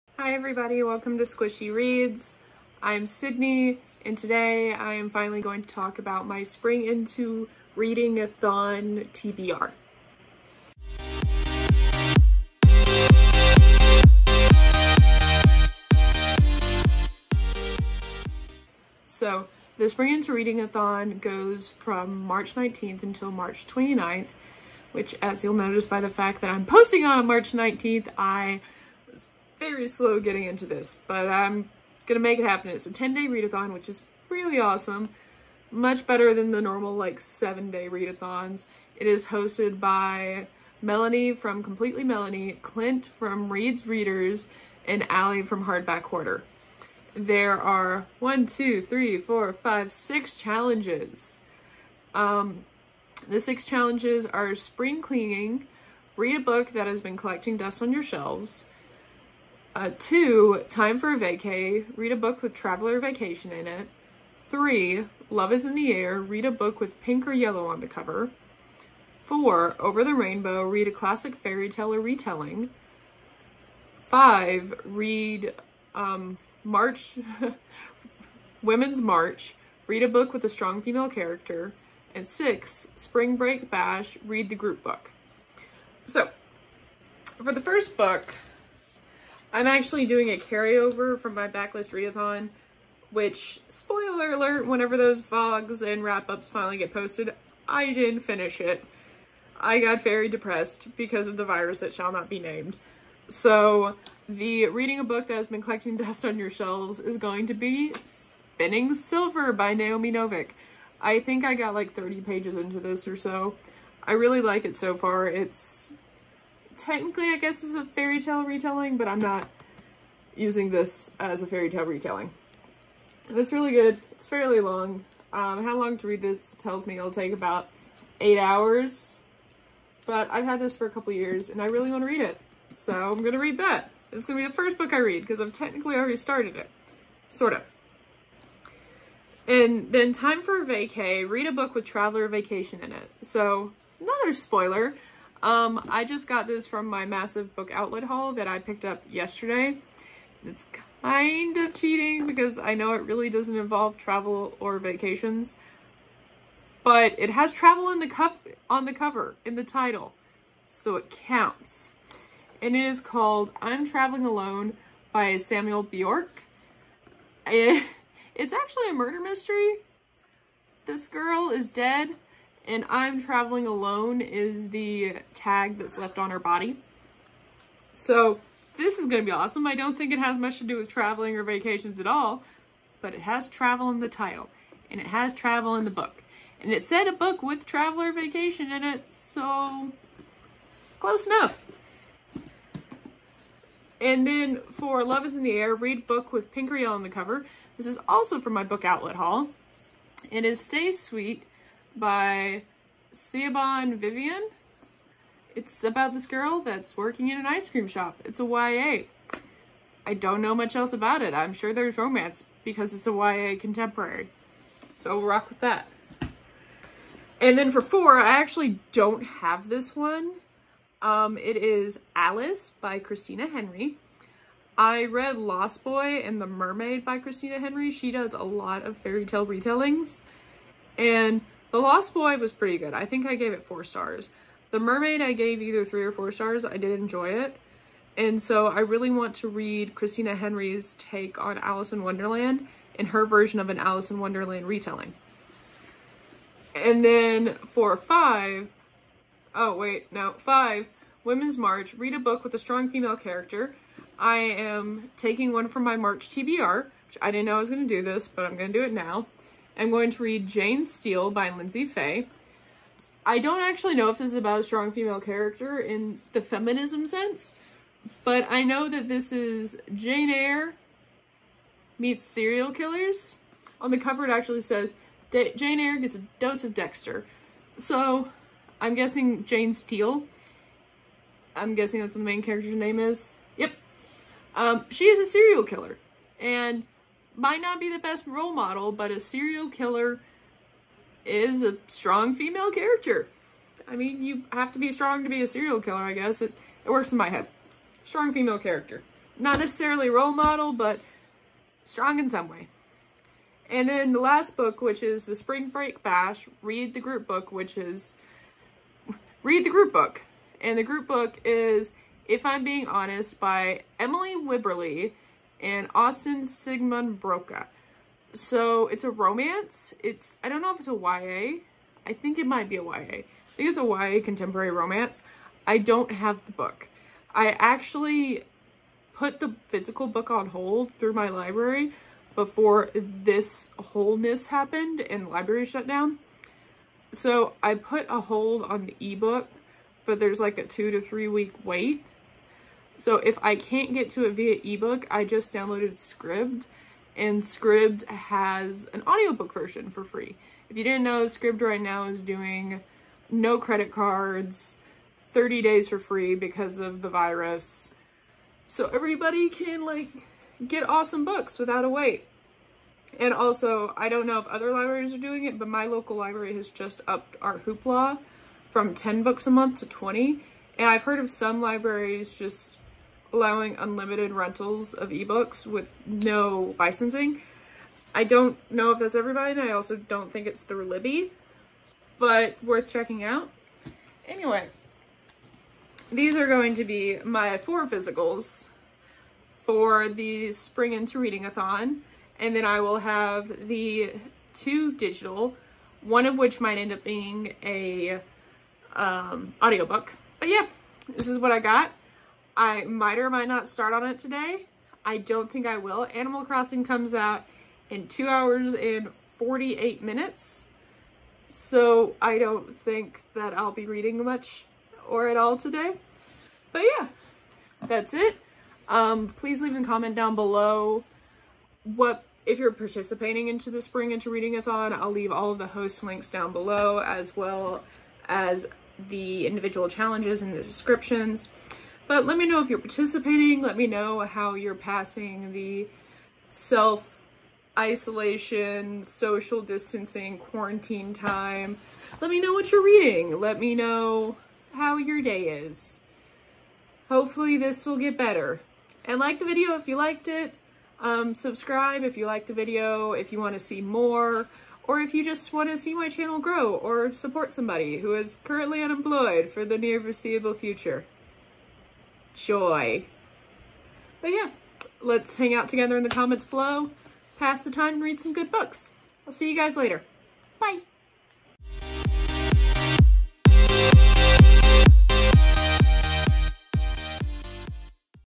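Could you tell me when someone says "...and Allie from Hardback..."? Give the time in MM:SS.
00:44.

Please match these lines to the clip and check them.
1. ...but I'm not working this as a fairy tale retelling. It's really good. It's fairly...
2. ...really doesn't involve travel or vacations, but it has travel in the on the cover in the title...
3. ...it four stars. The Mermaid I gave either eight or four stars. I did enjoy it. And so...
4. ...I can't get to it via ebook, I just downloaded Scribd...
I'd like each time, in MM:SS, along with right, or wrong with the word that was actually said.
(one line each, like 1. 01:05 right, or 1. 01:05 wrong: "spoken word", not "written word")
1. 01:58 wrong: "using", not "working"
2. 02:33 right
3. 03:53 wrong: "three", not "eight"
4. 05:43 right.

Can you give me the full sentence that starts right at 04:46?
And might not be the best role model, but a serial killer is a strong female character.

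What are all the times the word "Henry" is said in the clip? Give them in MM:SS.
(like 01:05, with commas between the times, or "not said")
03:43, 03:47, 04:00.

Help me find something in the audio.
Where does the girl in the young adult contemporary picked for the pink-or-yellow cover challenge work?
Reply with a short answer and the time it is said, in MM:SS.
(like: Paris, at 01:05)
an ice cream shop, at 03:27.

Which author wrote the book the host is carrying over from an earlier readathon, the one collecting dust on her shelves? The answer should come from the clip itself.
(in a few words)
Naomi Novik.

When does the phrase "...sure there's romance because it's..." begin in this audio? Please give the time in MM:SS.
03:31.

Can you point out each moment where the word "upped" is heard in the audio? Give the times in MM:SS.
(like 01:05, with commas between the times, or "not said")
06:07.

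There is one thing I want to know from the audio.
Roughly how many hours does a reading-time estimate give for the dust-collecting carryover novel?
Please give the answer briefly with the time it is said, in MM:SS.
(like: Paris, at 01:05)
8, at 02:08.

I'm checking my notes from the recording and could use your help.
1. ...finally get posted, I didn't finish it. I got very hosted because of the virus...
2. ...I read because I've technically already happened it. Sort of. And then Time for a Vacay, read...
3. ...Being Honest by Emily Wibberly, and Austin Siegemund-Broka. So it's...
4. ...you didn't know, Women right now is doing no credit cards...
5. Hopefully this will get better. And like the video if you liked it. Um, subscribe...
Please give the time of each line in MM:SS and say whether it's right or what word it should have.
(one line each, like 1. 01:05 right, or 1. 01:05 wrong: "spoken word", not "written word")
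1. 01:36 wrong: "depressed", not "hosted"
2. 02:14 wrong: "started", not "happened"
3. 05:12 right
4. 05:50 wrong: "Scribd", not "Women"
5. 07:27 right.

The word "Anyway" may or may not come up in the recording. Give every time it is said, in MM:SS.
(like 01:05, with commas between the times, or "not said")
06:24.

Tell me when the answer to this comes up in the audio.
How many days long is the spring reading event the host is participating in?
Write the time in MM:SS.
00:32.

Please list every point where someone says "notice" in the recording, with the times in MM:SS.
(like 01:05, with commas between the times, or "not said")
00:25.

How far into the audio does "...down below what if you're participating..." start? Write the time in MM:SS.
07:00.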